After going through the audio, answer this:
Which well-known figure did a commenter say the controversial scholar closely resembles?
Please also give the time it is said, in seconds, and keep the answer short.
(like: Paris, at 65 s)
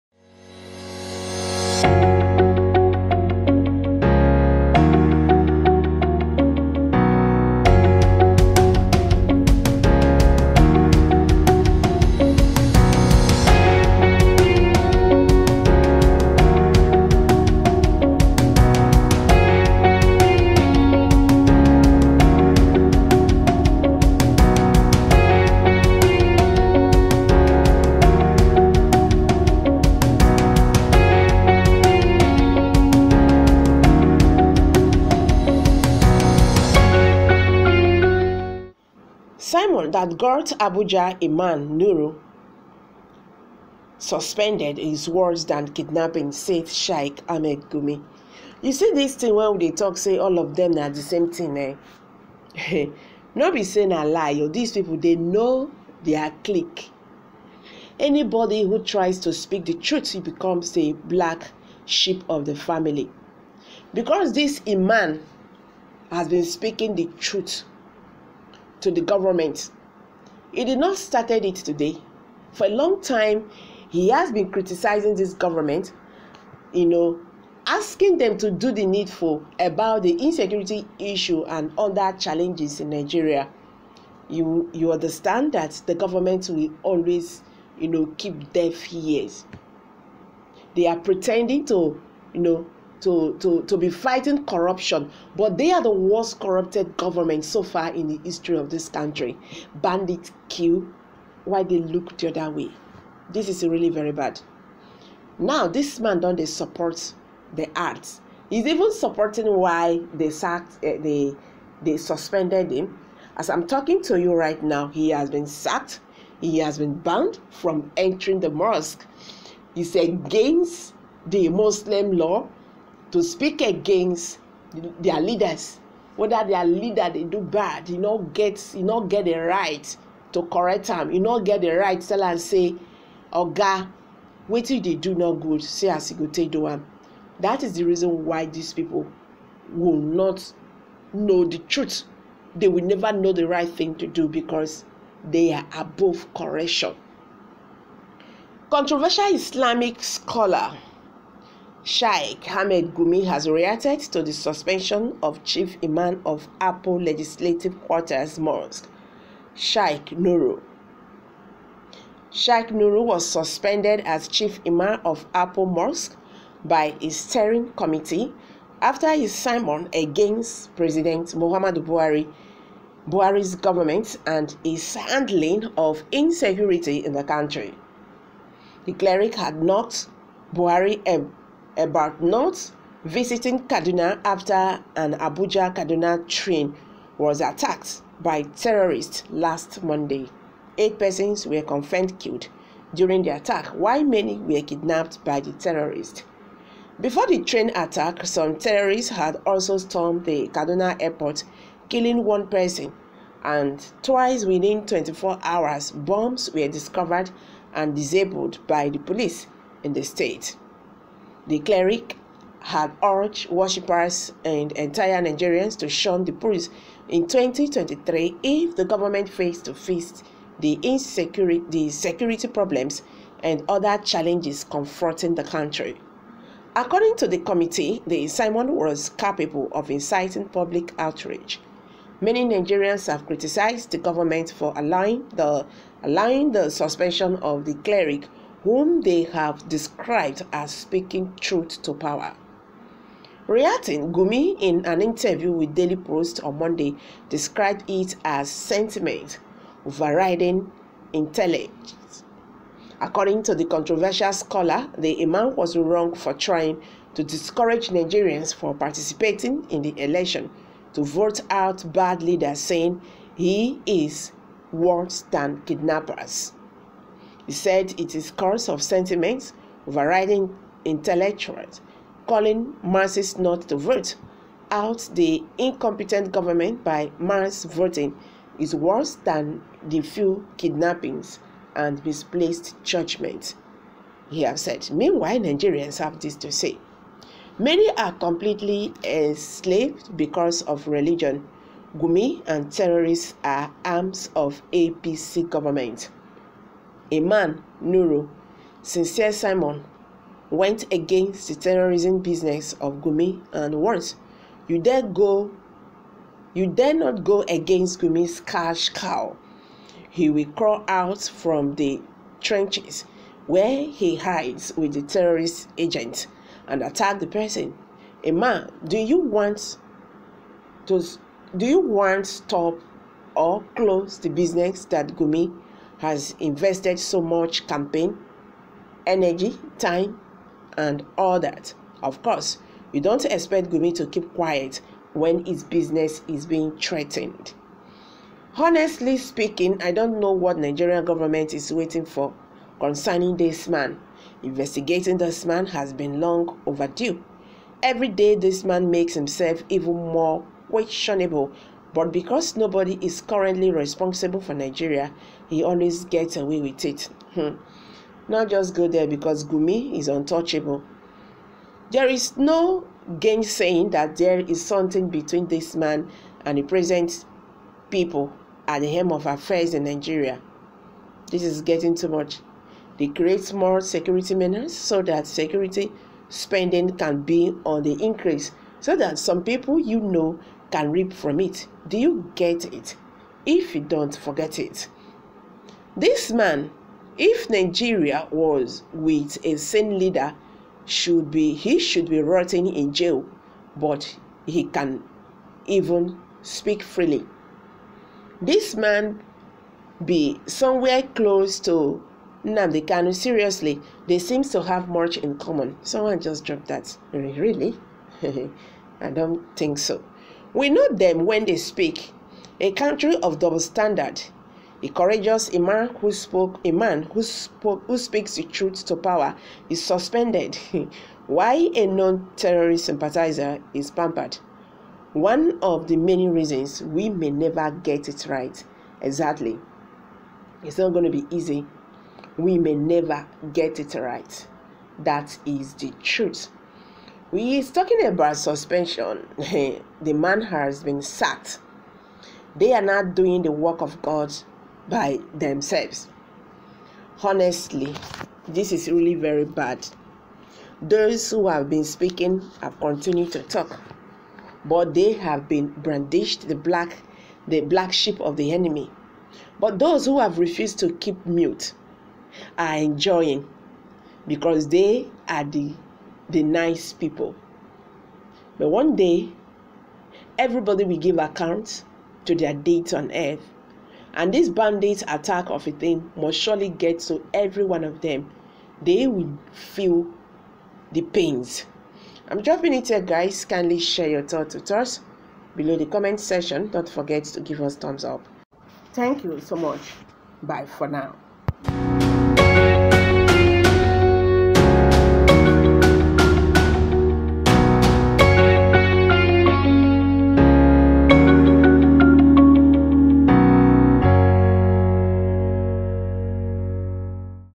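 Nnamdi Kanu, at 402 s.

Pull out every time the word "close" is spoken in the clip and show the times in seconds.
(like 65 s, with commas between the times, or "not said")
323 s, 401 s.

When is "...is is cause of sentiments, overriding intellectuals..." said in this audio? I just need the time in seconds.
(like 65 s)
268 s.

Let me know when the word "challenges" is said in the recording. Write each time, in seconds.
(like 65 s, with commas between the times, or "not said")
82 s, 224 s.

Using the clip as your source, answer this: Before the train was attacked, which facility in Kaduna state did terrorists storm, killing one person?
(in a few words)
Kaduna airport.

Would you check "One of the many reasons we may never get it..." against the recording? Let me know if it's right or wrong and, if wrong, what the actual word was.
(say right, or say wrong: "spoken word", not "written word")
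right.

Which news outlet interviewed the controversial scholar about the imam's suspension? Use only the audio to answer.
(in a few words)
Daily Post.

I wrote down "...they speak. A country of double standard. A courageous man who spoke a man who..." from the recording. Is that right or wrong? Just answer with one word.
right.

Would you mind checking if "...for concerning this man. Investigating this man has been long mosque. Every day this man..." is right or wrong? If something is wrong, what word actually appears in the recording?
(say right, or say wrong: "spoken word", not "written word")
wrong: "overdue", not "mosque".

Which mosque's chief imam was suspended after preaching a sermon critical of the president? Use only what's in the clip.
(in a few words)
Apo Legislative Quarters Mosque.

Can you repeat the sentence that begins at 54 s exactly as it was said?
Oh, these people they know their clique.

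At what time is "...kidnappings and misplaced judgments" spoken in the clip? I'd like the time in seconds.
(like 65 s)
280 s.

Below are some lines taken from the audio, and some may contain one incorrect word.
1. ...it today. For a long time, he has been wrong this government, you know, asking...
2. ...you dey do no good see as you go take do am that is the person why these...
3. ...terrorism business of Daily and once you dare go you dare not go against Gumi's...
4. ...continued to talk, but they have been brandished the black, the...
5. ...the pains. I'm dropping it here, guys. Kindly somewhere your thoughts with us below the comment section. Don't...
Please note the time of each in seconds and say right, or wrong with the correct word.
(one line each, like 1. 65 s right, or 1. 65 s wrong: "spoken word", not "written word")
1. 71 s wrong: "criticizing", not "wrong"
2. 134 s wrong: "reason", not "person"
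3. 301 s wrong: "Gumi", not "Daily"
4. 452 s right
5. 480 s wrong: "share", not "somewhere".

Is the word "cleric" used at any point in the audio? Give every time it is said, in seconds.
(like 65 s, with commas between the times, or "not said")
178 s, 211 s, 237 s.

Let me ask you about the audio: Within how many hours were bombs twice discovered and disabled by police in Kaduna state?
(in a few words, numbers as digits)
24.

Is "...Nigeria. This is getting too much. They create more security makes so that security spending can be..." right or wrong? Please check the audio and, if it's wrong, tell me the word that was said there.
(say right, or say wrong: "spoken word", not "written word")
wrong: "measures", not "makes".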